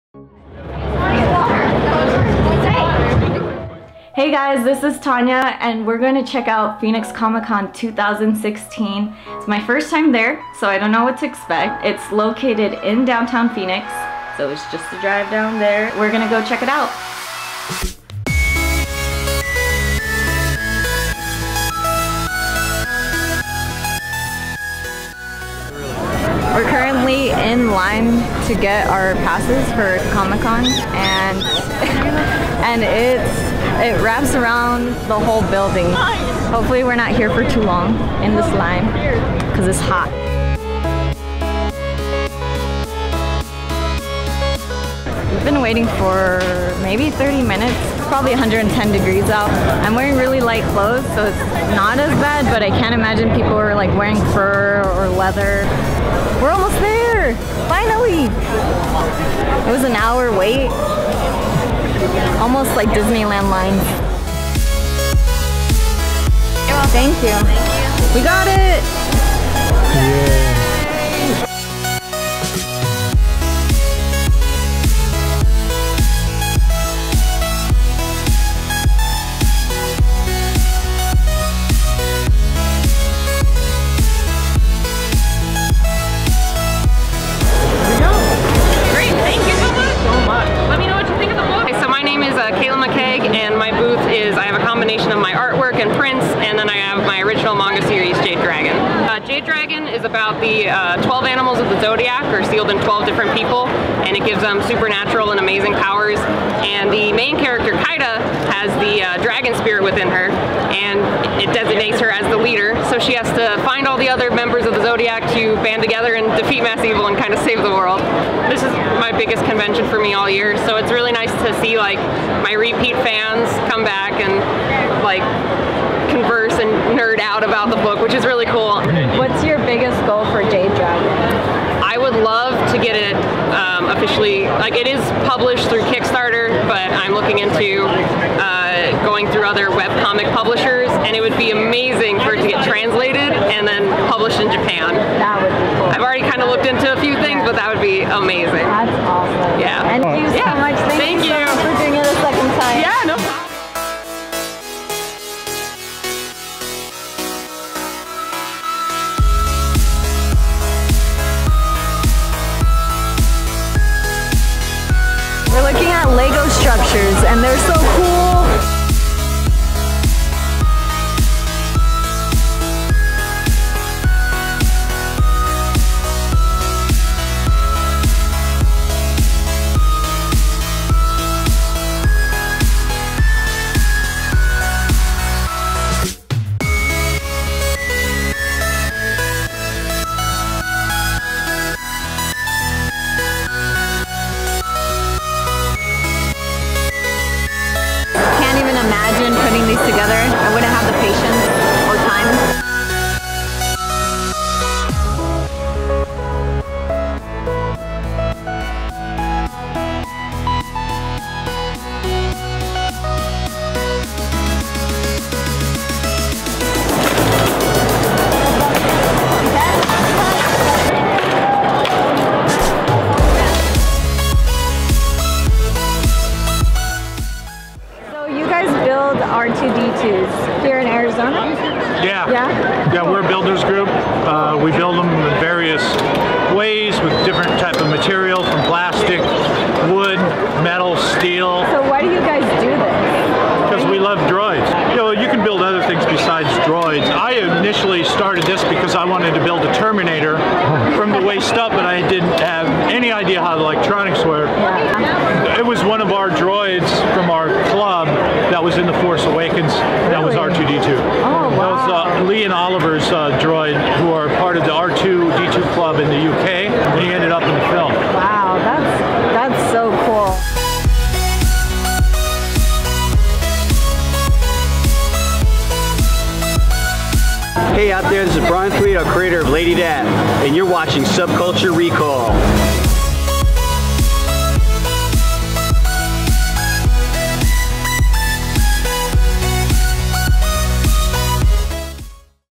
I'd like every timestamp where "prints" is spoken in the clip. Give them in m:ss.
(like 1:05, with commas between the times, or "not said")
1:35.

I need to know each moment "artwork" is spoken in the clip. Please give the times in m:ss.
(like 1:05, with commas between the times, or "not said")
1:35.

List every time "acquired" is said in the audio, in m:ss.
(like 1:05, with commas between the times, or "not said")
not said.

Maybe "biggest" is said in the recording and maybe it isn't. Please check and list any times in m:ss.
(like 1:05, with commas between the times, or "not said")
1:59, 2:09.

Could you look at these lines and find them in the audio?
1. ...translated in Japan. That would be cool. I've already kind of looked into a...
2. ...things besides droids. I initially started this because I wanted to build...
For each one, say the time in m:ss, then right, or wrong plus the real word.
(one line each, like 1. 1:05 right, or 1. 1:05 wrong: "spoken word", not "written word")
1. 2:24 wrong: "published", not "translated"
2. 4:05 right.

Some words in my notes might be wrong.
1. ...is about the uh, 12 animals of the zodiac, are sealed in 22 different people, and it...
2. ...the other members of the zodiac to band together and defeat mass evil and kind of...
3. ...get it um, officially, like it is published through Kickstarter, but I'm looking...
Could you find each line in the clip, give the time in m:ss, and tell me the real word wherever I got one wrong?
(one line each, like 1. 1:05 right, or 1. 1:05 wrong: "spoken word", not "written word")
1. 1:39 wrong: "12", not "22"
2. 1:53 right
3. 2:12 right.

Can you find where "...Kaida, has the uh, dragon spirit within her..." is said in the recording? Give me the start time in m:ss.
1:47.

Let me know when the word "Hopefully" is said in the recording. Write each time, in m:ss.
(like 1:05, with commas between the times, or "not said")
0:36.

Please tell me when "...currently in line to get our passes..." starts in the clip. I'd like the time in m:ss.
0:26.